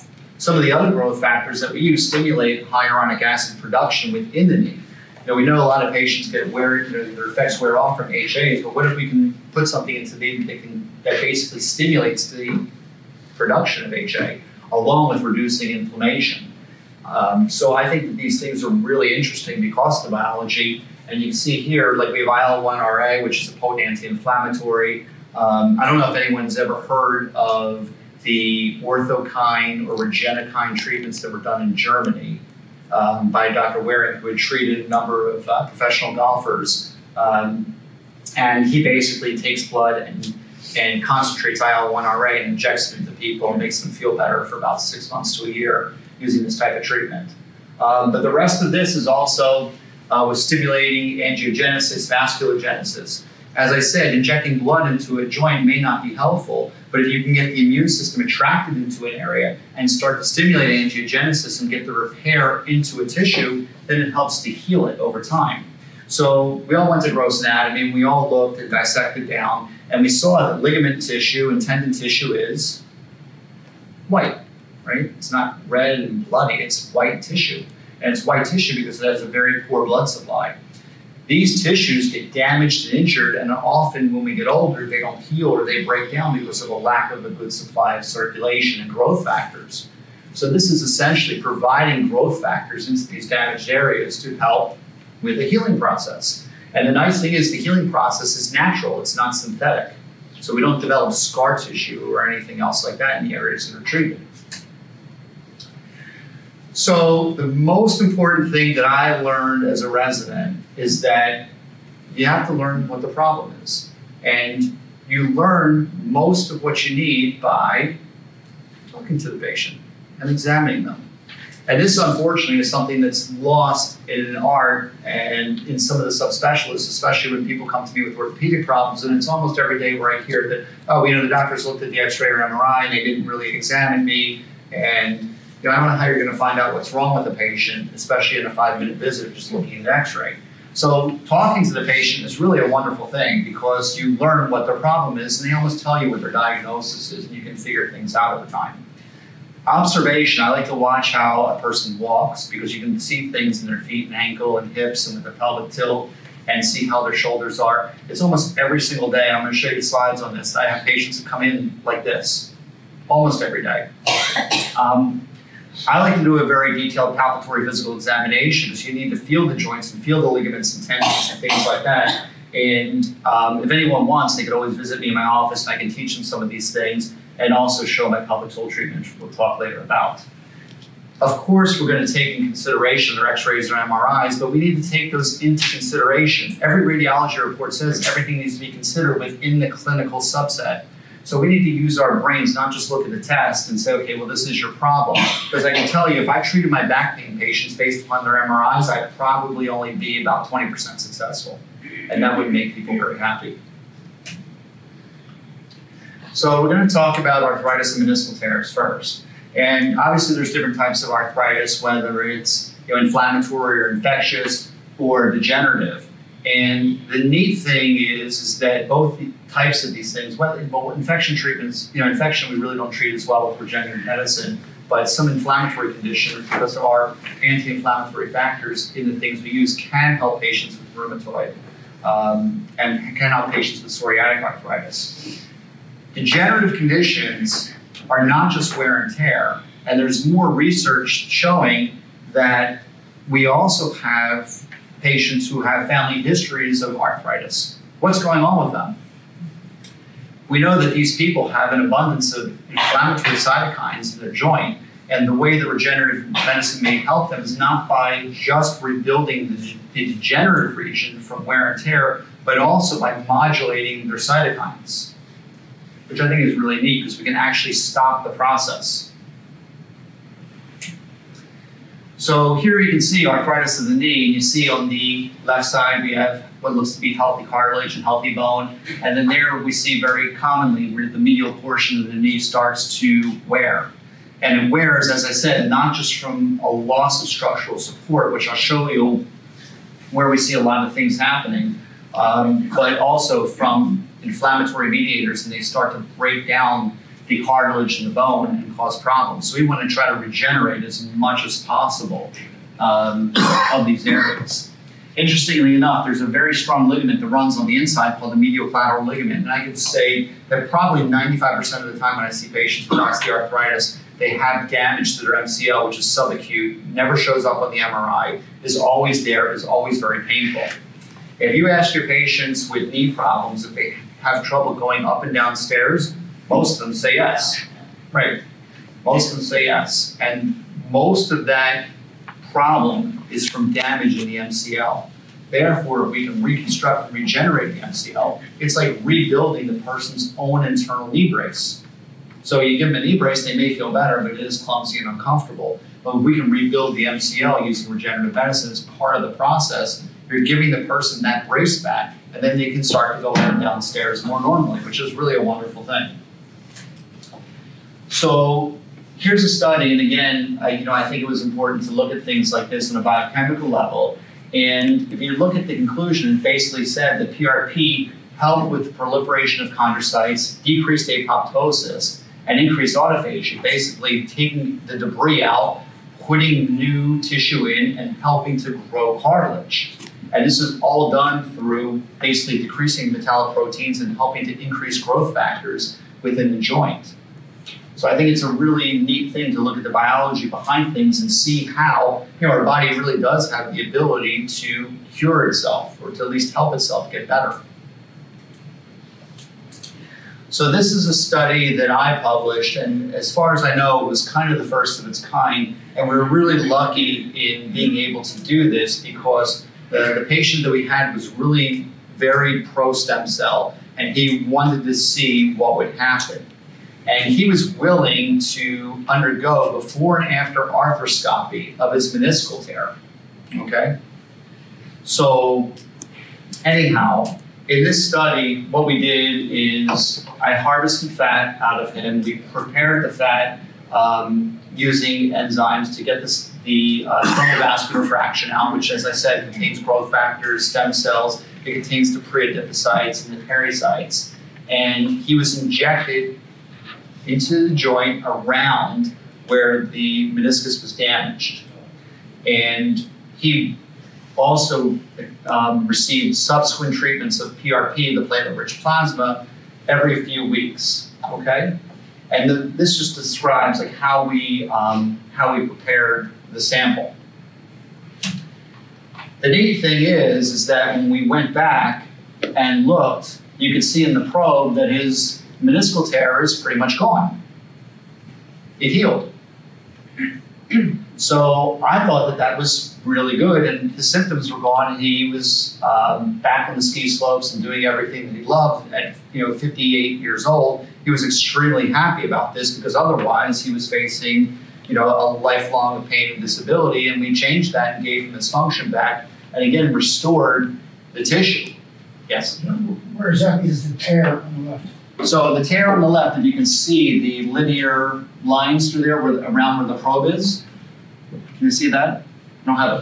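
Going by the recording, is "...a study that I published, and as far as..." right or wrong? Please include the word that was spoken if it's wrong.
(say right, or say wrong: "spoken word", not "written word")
right.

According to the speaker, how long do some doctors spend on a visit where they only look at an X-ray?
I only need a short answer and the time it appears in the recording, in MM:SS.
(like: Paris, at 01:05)
5 minutes, at 02:18.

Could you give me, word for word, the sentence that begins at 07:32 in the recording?
And he also um, received subsequent treatments of PRP, the platelet-rich plasma, every few weeks.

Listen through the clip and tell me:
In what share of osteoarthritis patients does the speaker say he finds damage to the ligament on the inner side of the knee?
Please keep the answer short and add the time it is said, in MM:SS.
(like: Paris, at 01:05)
95%, at 05:11.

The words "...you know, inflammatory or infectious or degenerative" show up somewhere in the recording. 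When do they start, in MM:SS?
03:32.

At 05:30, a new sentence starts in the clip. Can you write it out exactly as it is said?
And most of that problem is from damage in the MCL.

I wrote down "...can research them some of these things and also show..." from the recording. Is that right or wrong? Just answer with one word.
wrong.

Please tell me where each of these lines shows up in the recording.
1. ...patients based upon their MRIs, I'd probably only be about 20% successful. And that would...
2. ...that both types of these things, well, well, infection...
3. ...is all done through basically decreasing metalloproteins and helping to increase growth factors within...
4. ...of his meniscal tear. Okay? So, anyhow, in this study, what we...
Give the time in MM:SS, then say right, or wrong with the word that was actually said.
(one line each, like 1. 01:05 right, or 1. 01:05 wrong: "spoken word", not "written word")
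1. 03:17 right
2. 03:38 right
3. 06:20 right
4. 07:01 right.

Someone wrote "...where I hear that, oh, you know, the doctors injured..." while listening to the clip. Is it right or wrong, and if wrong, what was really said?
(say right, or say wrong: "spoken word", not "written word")
wrong: "looked", not "injured".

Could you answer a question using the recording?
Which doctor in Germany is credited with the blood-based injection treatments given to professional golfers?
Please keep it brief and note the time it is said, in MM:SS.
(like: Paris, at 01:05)
Dr. Wehling, at 00:33.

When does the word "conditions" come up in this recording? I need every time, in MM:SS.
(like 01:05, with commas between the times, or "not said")
03:45, 03:56.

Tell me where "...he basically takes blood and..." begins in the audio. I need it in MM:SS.
00:38.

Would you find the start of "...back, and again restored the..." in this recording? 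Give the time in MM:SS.
08:18.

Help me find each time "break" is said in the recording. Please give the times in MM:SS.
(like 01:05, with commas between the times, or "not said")
01:25, 04:56.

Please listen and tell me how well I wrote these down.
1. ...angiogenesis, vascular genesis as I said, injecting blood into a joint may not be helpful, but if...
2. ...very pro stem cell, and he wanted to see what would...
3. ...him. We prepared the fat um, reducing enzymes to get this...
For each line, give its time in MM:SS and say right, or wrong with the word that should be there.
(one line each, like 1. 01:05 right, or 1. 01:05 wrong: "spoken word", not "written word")
1. 00:51 right
2. 06:52 right
3. 07:11 wrong: "using", not "reducing".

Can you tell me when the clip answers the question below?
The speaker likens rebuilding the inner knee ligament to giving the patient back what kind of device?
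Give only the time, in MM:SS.
05:40.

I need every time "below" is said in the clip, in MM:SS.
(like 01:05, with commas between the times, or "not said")
not said.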